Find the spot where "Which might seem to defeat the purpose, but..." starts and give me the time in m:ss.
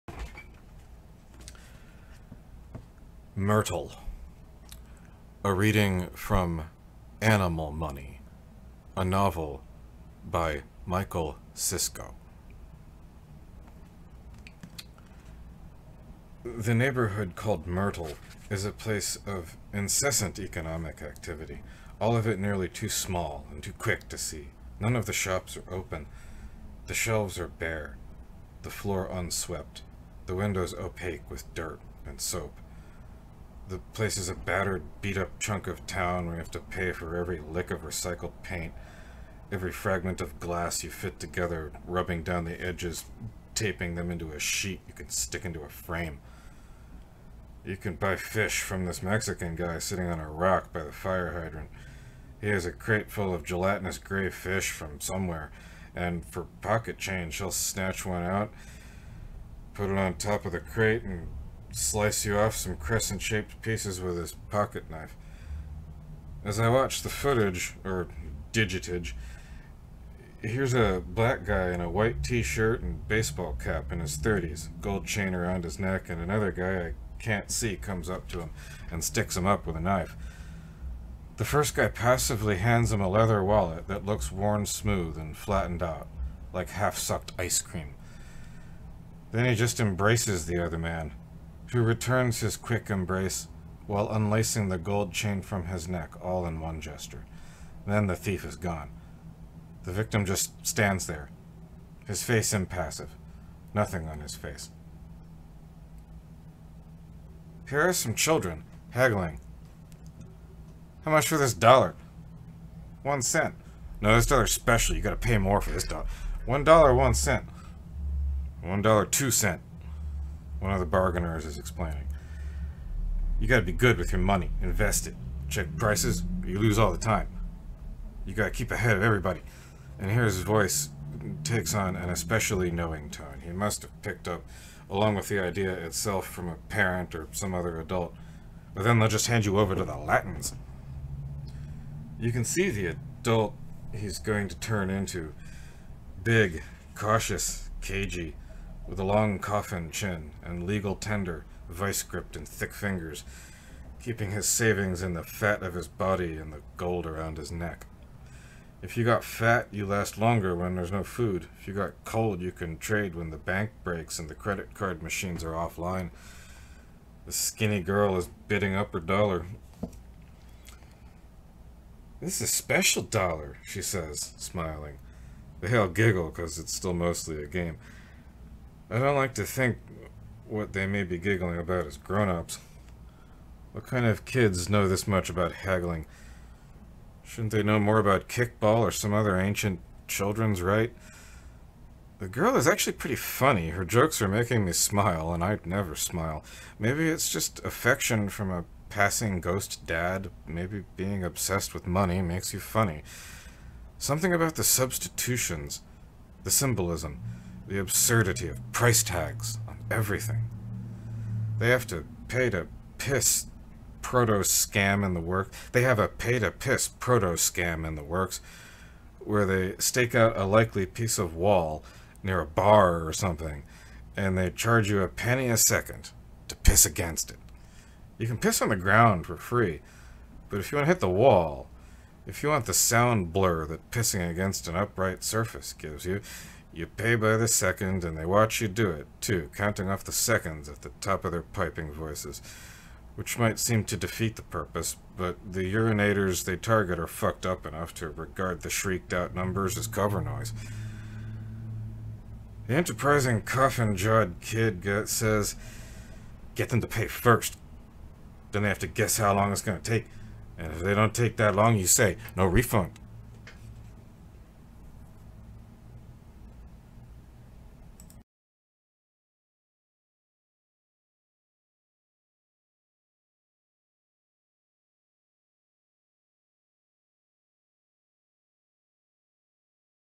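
4:03.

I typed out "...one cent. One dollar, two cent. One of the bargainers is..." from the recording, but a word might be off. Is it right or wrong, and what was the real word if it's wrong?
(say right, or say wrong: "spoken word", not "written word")
right.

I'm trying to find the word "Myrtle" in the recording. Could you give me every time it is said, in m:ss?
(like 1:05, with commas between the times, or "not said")
0:03, 0:17.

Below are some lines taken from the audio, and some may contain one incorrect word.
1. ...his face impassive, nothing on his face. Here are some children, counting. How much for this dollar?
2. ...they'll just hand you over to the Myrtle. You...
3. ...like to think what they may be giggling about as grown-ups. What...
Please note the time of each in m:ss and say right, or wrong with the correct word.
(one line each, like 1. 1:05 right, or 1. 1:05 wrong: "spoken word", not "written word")
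1. 1:42 wrong: "haggling", not "counting"
2. 2:18 wrong: "Latins", not "Myrtle"
3. 2:59 right.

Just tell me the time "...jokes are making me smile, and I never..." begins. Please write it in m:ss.
3:13.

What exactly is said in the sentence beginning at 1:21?
The first guy passively hands him a leather wallet that looks worn smooth and flattened out, like half-sucked ice cream.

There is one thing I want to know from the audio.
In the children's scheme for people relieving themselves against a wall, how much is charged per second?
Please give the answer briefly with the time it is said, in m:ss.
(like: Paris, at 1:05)
a penny, at 3:45.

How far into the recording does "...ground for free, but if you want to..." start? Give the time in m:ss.
3:48.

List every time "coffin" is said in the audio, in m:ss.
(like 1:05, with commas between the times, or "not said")
2:29, 4:13.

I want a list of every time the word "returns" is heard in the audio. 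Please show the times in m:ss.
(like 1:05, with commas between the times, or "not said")
1:31.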